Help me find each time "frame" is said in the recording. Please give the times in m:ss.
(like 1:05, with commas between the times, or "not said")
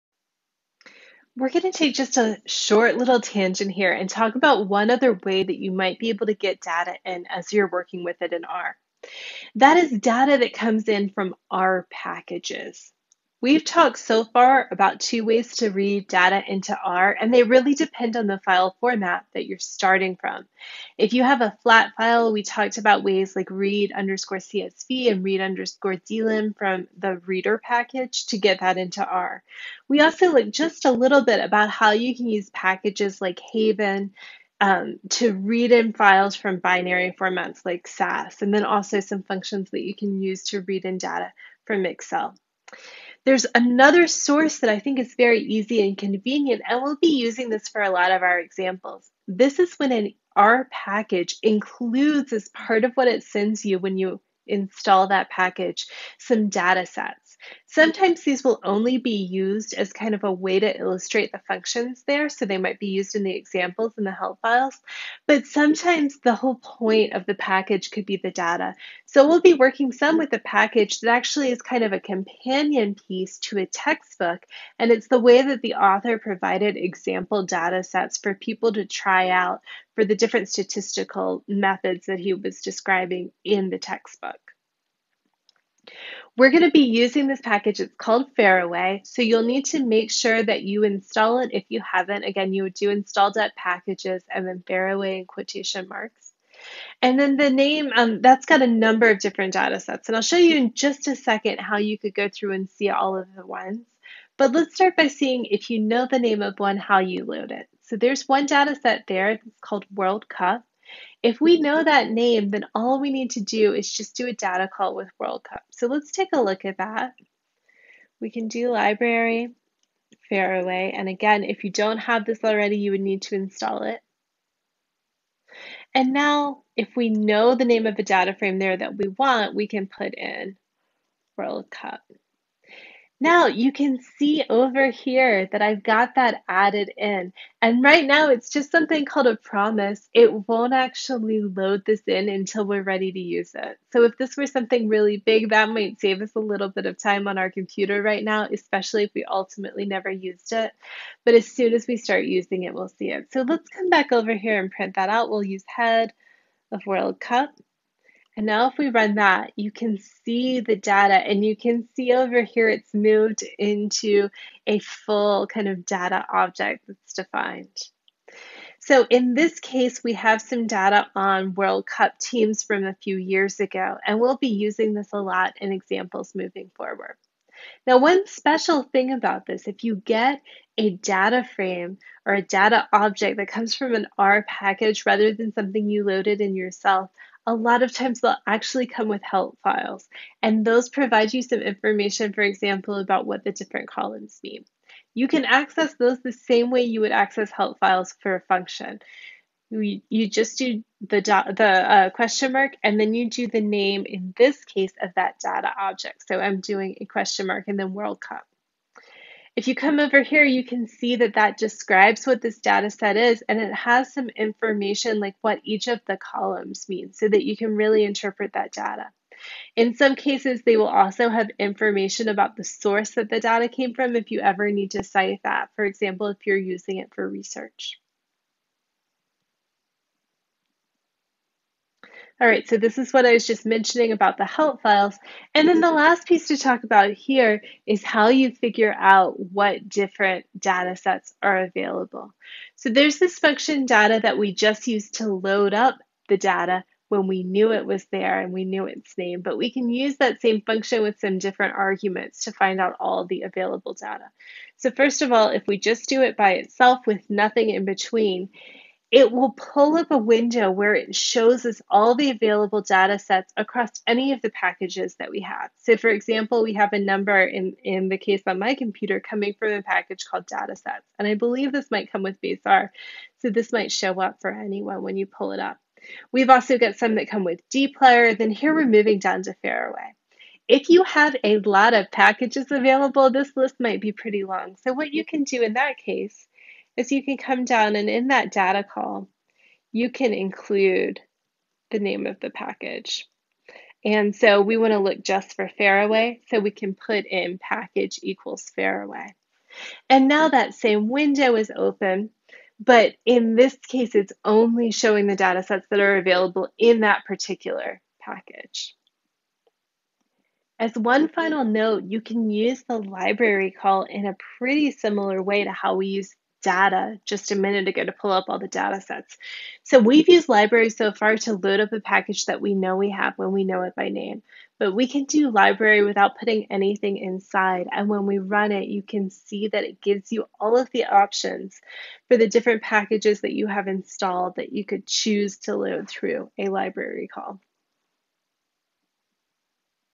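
2:08, 3:01.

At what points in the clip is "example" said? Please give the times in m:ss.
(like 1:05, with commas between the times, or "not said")
0:48, 1:03, 1:16, 2:55, 3:12, 3:45, 4:26.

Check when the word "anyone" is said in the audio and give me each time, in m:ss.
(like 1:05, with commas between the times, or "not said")
4:34.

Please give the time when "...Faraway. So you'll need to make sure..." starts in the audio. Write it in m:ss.
1:28.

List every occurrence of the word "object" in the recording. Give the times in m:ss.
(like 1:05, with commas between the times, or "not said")
2:46, 3:02, 3:25.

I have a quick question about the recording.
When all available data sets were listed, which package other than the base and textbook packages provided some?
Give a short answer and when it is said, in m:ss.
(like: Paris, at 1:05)
dplyr, at 4:37.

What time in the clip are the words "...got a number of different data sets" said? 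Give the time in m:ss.
1:38.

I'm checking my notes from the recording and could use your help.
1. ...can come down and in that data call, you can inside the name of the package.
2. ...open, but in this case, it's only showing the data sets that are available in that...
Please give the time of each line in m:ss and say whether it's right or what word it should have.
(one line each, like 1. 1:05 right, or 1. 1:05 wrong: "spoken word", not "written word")
1. 4:47 wrong: "include", not "inside"
2. 5:01 right.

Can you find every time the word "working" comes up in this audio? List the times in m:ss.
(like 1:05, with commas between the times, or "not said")
0:07, 1:09.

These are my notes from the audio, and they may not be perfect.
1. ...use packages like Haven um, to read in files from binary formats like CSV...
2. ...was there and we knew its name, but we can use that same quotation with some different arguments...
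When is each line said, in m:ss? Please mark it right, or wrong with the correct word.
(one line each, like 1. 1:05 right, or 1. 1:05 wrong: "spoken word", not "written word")
1. 0:32 wrong: "SAS", not "CSV"
2. 4:07 wrong: "function", not "quotation".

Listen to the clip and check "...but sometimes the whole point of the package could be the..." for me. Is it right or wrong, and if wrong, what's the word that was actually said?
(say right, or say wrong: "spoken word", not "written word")
right.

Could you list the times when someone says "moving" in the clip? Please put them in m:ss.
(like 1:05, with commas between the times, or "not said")
2:56, 4:38.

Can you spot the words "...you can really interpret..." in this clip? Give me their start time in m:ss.
3:37.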